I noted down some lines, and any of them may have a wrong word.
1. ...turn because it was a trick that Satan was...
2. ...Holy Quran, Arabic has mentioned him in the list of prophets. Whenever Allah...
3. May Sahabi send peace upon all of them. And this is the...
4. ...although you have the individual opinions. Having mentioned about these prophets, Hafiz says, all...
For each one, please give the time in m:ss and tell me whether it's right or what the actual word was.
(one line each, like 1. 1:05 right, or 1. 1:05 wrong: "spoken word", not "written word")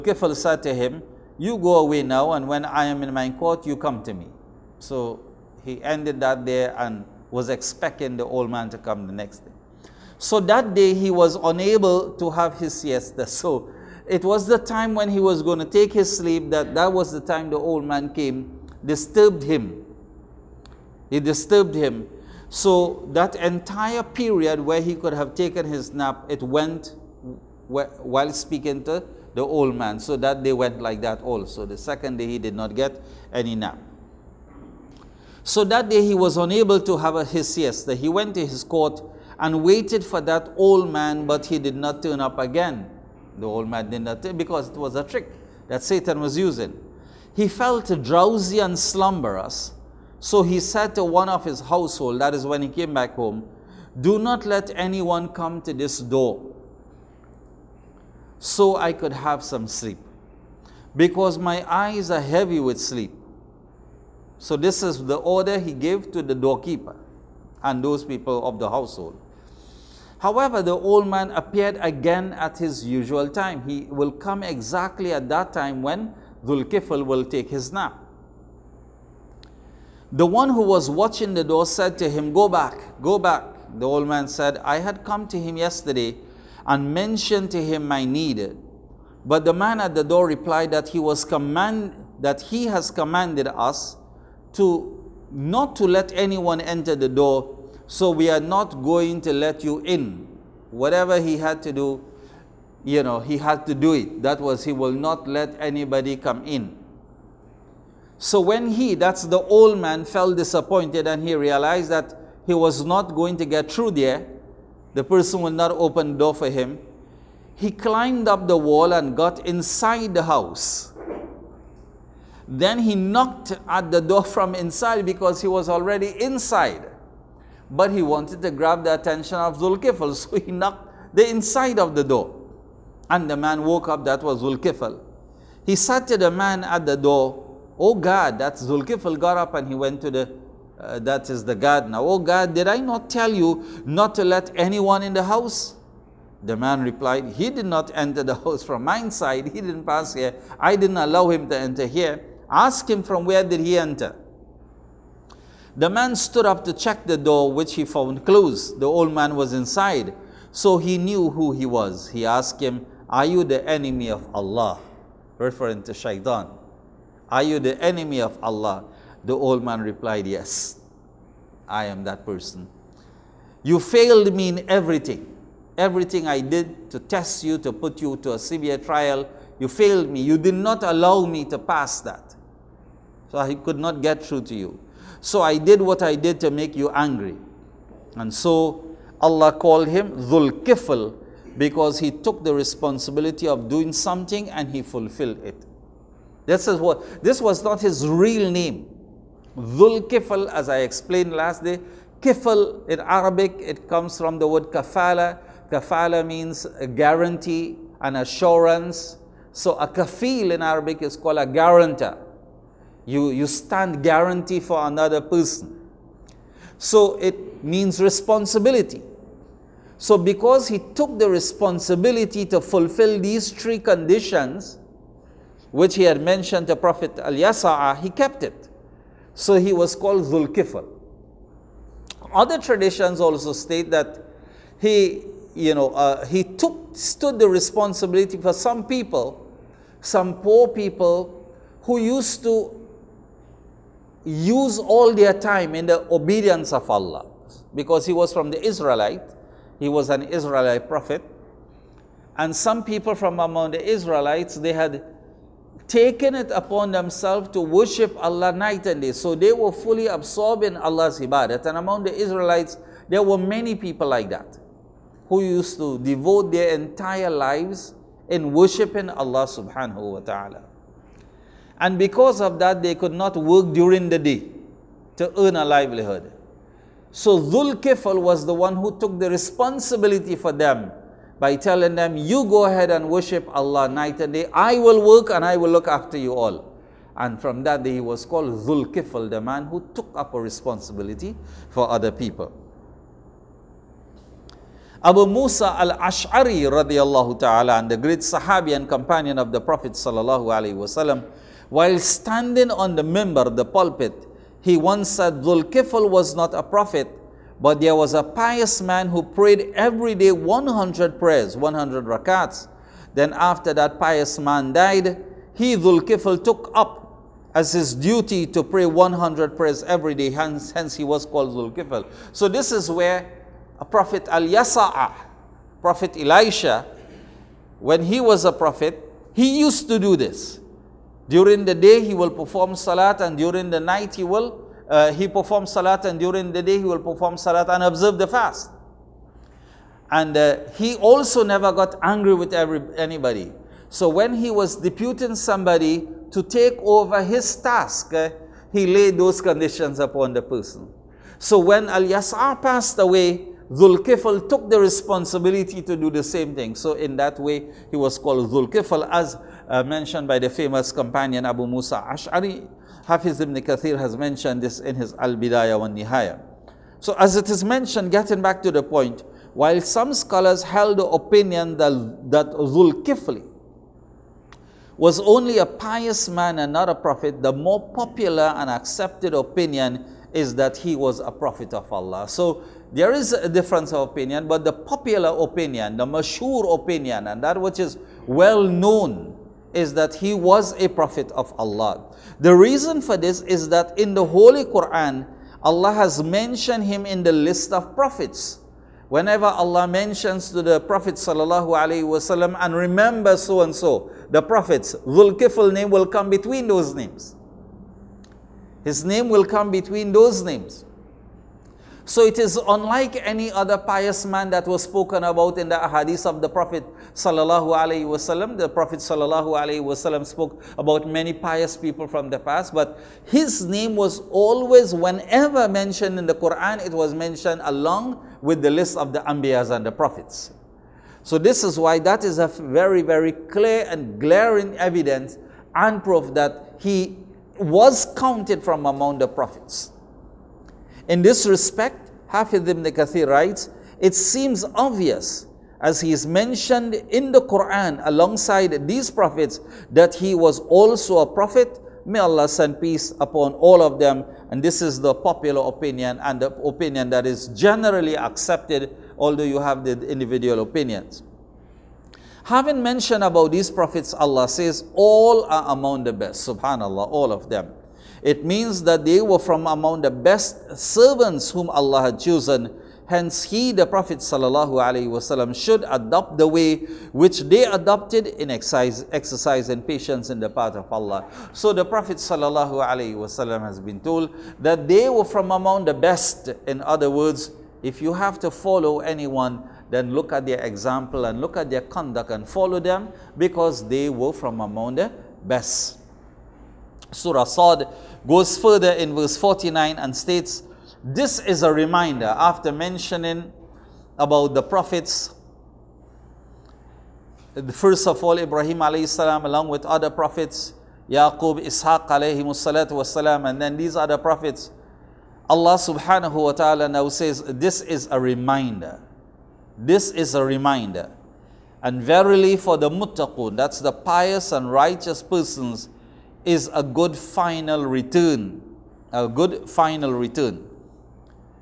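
1. 0:44 right
2. 6:34 wrong: "Allah", not "Arabic"
3. 7:32 wrong: "Allah", not "Sahabi"
4. 7:39 wrong: "Allah", not "Hafiz".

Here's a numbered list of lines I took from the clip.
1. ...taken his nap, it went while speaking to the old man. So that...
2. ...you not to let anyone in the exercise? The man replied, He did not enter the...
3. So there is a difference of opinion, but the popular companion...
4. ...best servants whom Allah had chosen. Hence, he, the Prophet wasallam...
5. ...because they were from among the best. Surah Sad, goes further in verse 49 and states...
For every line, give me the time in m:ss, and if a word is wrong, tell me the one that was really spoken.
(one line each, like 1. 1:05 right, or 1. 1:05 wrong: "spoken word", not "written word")
1. 0:25 right
2. 2:23 wrong: "house", not "exercise"
3. 6:22 wrong: "opinion", not "companion"
4. 7:50 right
5. 8:13 right.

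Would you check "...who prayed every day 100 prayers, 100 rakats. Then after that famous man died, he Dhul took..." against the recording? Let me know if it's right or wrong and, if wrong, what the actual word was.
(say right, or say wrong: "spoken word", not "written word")
wrong: "pious", not "famous".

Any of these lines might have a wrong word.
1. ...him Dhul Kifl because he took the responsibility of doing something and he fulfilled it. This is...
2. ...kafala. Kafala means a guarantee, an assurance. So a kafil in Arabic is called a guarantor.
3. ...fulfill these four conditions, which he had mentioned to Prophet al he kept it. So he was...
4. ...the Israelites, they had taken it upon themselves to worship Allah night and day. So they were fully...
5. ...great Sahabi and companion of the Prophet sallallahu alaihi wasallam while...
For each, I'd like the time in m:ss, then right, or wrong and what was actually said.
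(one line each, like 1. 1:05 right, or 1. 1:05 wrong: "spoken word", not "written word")
1. 3:09 right
2. 3:24 right
3. 3:42 wrong: "three", not "four"
4. 4:13 right
5. 4:57 right.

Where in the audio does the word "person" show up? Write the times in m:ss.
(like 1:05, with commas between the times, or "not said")
1:55, 2:52, 3:35, 5:50, 8:45.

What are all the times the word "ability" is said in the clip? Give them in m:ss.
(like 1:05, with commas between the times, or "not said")
not said.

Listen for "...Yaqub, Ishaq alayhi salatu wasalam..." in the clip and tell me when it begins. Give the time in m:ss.
8:31.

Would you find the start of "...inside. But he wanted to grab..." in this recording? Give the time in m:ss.
2:06.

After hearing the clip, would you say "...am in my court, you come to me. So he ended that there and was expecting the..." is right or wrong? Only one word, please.
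right.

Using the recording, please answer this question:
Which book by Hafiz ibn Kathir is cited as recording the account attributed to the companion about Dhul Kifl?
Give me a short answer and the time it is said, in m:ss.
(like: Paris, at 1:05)
Al Bidayah wa Nihaya, at 6:05.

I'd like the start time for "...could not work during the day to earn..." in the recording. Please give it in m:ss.
4:32.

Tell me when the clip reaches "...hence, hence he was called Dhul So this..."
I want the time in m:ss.
5:20.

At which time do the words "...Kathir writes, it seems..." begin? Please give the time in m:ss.
7:22.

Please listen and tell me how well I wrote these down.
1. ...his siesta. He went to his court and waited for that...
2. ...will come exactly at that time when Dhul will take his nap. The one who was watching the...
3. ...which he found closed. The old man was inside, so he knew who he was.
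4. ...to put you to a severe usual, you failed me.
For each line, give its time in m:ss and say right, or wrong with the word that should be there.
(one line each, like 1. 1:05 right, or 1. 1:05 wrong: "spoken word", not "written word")
1. 0:37 right
2. 1:13 right
3. 2:37 right
4. 2:57 wrong: "trial", not "usual".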